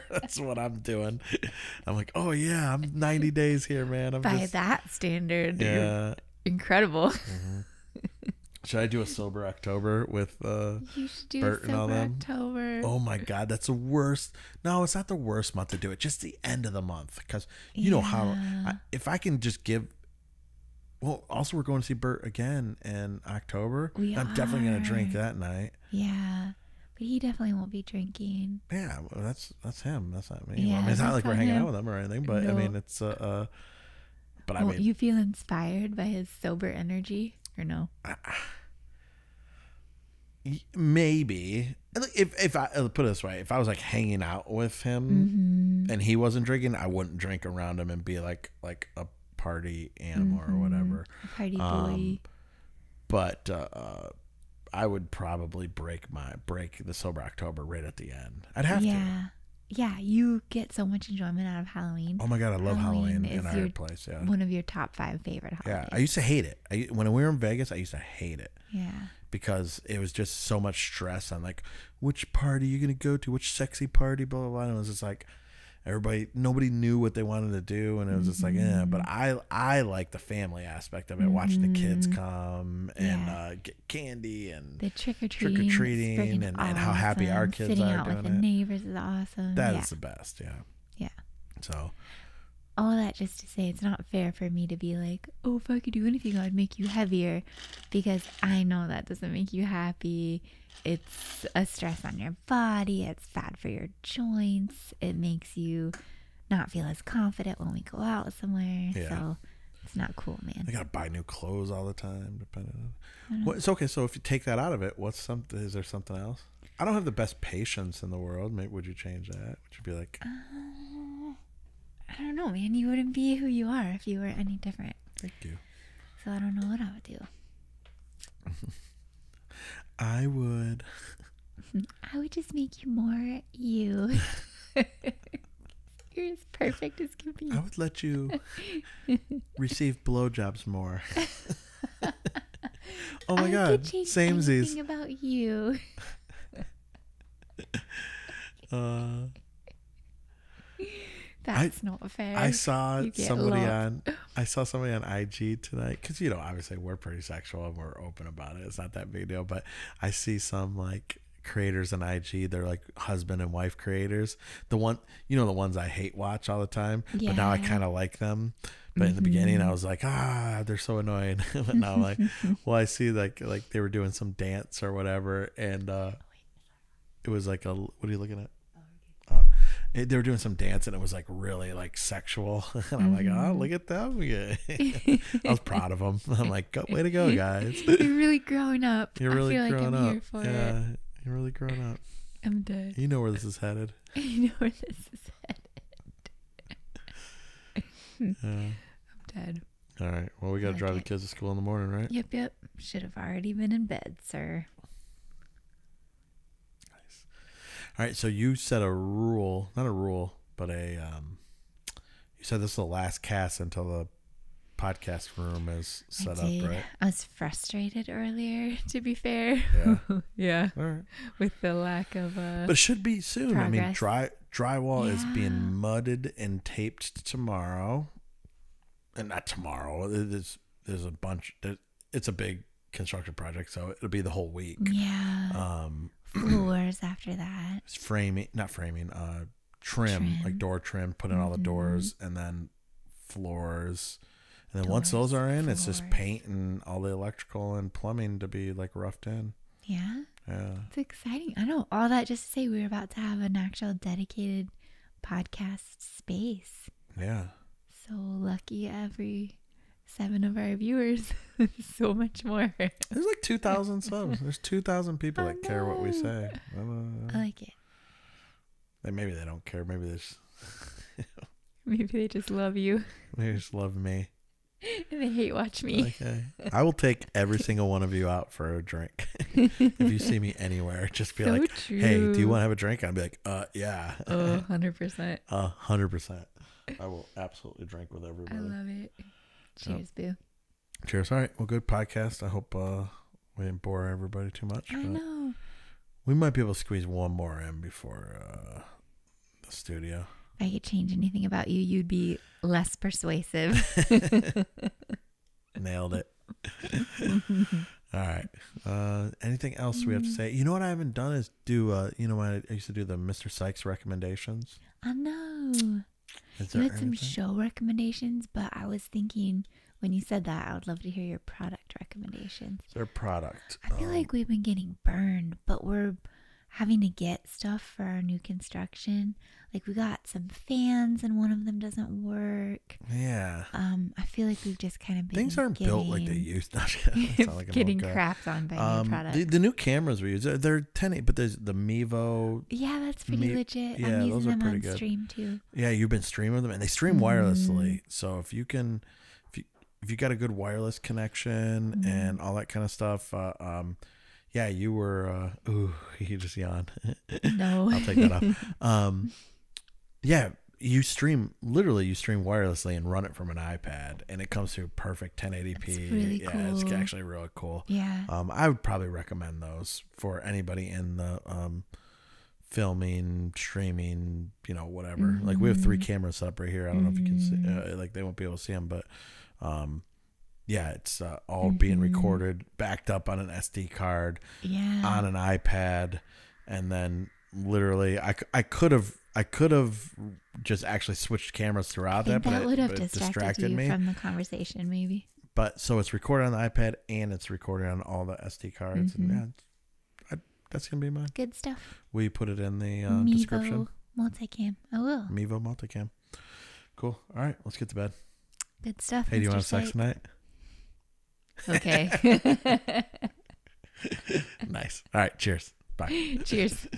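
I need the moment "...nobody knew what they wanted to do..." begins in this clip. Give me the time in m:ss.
1:16.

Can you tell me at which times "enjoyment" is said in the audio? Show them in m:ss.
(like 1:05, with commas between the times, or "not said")
1:01.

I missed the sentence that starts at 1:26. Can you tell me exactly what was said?
and how happy our kids Sitting are out doing with the it.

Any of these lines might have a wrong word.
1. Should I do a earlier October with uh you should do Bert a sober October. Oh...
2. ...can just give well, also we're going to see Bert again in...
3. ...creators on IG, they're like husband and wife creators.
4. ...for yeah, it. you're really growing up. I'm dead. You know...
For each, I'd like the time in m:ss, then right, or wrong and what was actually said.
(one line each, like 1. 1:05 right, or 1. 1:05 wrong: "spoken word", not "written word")
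1. 0:08 wrong: "sober", not "earlier"
2. 0:19 right
3. 2:41 right
4. 3:10 right.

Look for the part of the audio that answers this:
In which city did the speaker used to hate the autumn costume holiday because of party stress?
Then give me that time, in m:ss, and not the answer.
1:07.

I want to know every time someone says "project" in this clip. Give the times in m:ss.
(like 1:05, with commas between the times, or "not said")
3:53.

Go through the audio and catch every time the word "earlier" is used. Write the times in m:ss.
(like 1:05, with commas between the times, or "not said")
3:38.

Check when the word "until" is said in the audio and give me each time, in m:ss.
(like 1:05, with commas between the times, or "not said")
3:33.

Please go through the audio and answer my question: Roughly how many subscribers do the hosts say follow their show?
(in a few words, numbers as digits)
2,000.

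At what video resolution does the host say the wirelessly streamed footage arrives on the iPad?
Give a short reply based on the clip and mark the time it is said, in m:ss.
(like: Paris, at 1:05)
1080p, at 6:05.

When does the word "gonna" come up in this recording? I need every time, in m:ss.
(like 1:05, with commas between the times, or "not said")
1:12, 6:40.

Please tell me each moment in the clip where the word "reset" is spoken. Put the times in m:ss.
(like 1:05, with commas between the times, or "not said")
not said.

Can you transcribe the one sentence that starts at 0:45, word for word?
and he wasn't drinking, I wouldn't drink around him and be like like a party animal mm-hmm.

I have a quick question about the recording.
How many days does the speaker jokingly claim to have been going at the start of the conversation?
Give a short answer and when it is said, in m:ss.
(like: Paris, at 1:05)
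90, at 0:02.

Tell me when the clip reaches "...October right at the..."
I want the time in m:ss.
0:57.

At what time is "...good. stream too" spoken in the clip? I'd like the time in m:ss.
5:44.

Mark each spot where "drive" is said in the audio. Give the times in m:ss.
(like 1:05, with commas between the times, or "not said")
3:20.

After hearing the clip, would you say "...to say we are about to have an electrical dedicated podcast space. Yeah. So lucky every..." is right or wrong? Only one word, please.
wrong.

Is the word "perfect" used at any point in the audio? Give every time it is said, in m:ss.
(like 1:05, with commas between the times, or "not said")
2:16, 6:04.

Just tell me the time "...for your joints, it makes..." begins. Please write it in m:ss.
1:43.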